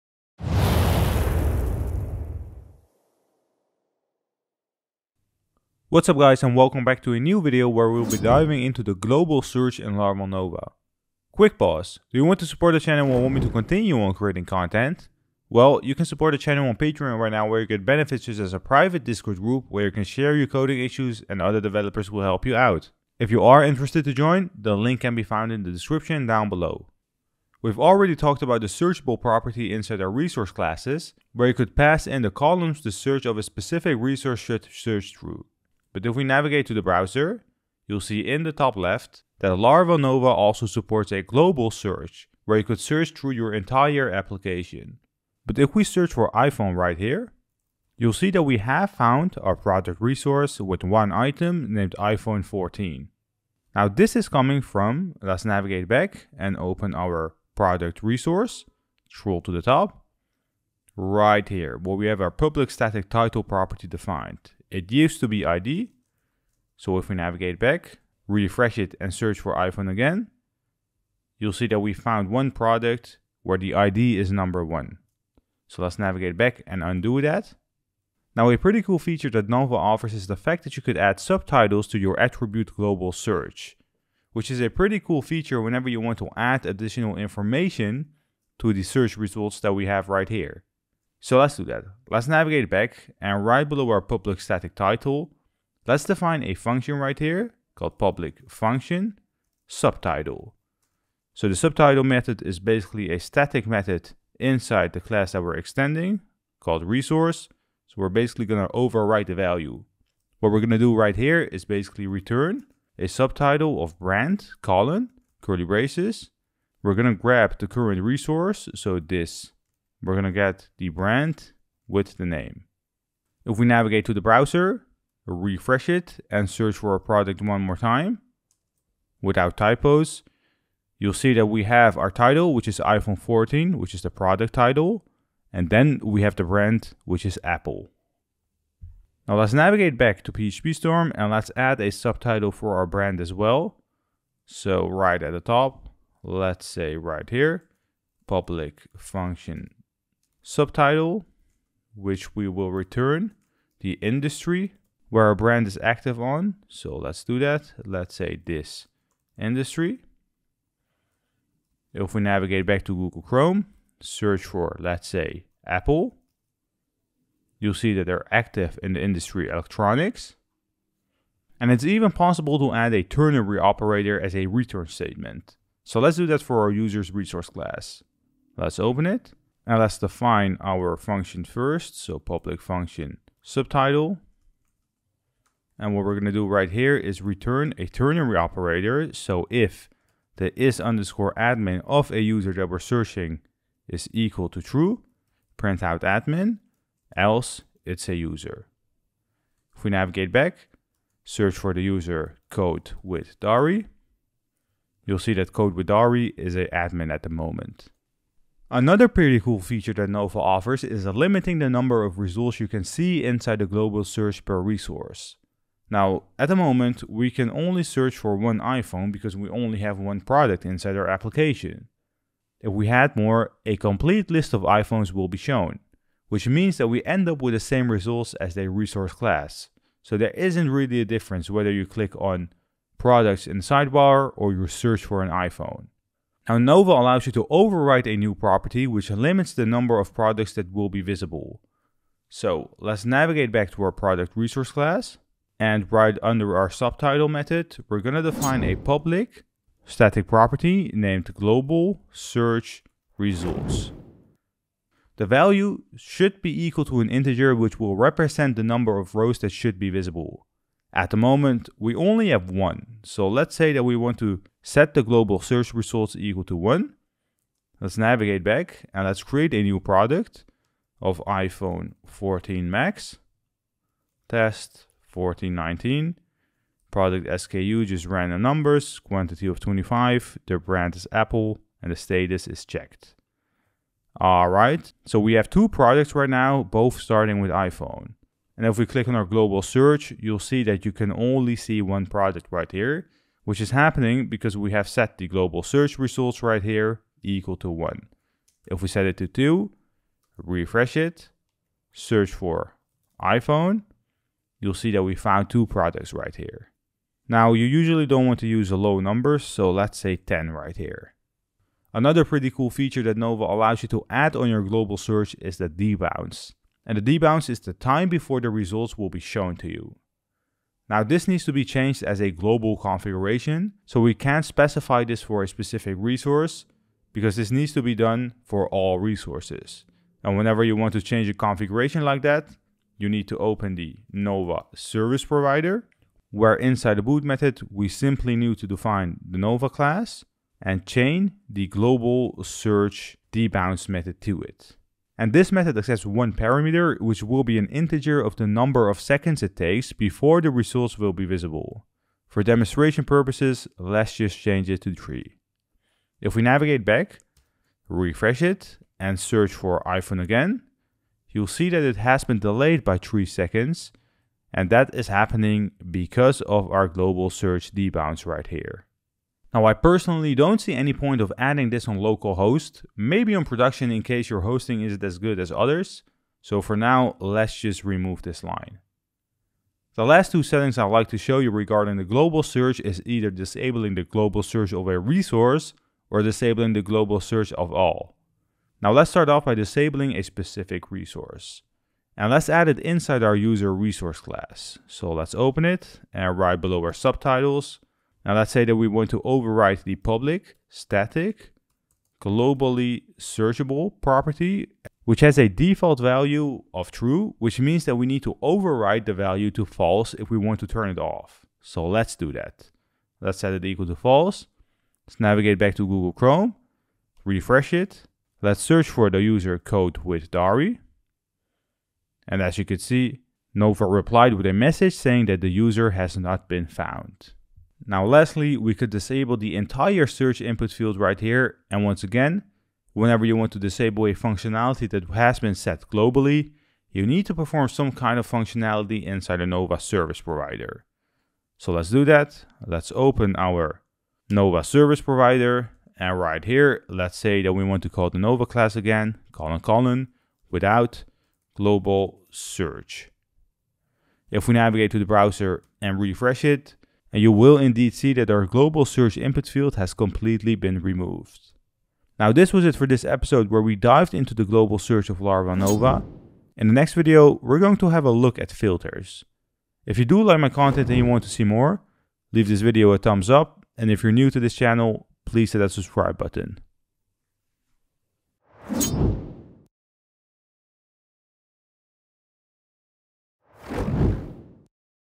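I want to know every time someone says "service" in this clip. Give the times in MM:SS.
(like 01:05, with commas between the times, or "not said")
05:34, 07:19, 07:24.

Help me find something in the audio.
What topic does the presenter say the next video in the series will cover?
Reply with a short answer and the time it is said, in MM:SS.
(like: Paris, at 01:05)
Filters, at 07:48.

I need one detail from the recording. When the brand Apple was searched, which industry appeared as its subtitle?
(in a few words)
electronics.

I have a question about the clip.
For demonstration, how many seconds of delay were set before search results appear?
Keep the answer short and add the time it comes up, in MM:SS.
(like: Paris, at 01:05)
3, at 05:53.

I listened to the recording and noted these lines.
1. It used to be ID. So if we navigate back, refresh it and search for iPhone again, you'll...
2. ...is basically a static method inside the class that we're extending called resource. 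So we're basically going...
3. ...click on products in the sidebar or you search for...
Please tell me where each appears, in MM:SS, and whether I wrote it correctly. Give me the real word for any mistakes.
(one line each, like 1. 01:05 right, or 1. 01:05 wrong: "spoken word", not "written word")
1. 01:04 right
2. 01:42 right
3. 03:51 right.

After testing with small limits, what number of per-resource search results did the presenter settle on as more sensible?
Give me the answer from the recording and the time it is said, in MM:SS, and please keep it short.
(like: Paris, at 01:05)
10, at 05:10.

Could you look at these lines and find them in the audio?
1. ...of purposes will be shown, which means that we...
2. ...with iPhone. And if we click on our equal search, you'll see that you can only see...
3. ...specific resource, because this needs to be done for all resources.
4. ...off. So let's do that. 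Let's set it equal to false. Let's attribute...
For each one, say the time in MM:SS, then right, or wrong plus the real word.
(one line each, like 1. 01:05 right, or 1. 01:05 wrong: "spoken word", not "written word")
1. 03:44 wrong: "iPhones", not "purposes"
2. 04:47 wrong: "global", not "equal"
3. 05:25 right
4. 06:50 wrong: "navigate", not "attribute".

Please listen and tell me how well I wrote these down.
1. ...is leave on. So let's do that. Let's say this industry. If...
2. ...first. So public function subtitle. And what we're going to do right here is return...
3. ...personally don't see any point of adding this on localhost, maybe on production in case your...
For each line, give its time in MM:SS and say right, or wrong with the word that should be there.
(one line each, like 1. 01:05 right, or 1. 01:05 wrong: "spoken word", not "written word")
1. 02:35 wrong: "active", not "leave"
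2. 03:01 right
3. 06:09 right.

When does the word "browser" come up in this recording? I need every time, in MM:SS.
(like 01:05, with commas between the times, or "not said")
00:36, 02:04, 07:35.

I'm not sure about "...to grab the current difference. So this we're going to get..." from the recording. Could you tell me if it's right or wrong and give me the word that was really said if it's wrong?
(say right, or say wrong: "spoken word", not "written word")
wrong: "resource", not "difference".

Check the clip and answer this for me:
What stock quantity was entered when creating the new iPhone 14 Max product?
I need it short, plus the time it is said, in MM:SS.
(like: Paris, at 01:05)
25, at 04:38.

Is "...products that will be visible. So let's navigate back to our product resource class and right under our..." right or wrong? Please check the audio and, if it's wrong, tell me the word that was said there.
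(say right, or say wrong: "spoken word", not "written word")
right.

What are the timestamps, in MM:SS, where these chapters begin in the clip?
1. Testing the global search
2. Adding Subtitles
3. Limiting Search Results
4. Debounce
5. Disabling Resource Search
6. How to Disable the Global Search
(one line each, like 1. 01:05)
1. 00:40
2. 01:13
3. 03:24
4. 05:06
5. 06:14
6. 07:02.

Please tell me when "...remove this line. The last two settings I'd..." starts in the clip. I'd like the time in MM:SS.
06:17.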